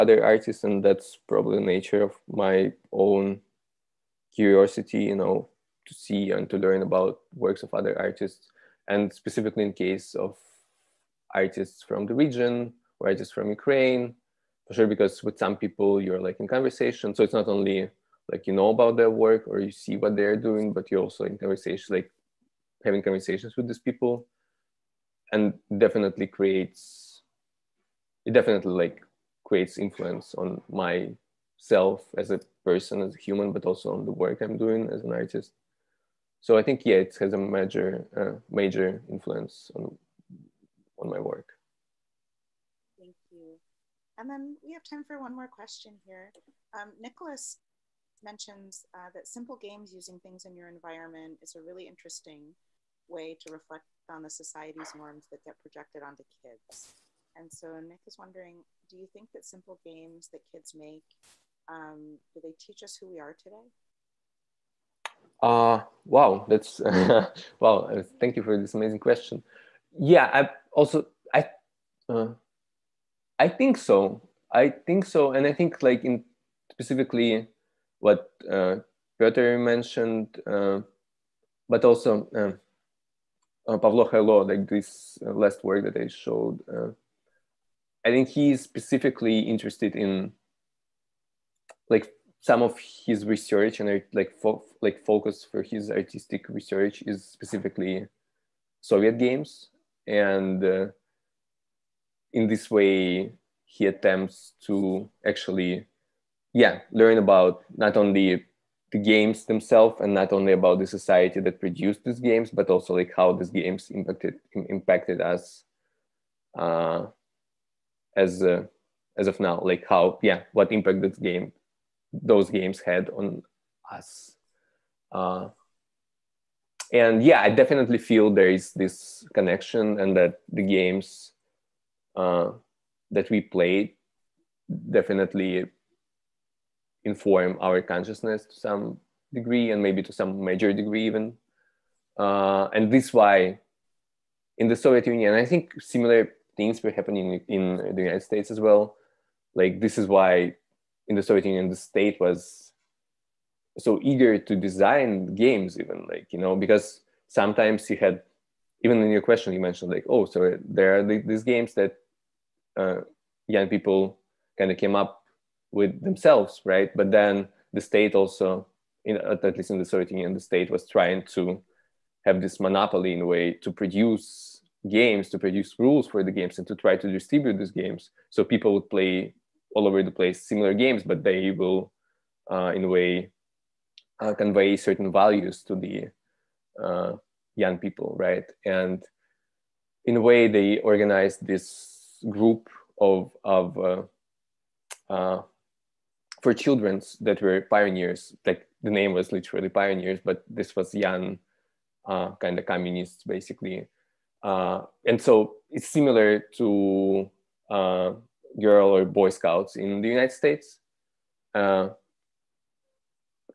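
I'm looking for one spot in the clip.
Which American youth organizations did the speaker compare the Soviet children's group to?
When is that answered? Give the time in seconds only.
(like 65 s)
208 s.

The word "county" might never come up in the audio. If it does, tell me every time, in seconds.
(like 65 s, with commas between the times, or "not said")
not said.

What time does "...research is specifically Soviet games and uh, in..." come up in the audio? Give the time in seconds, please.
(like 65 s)
96 s.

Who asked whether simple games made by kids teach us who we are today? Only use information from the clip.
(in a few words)
Nicholas.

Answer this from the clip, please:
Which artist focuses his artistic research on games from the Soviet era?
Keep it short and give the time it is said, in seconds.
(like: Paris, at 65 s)
Pavlo Khailo, at 83 s.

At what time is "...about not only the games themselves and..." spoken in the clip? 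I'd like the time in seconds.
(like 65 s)
107 s.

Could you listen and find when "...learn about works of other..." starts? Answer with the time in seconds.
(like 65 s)
6 s.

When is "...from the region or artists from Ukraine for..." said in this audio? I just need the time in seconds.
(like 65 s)
11 s.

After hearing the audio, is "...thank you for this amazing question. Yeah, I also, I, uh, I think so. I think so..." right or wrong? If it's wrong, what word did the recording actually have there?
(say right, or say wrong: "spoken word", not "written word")
right.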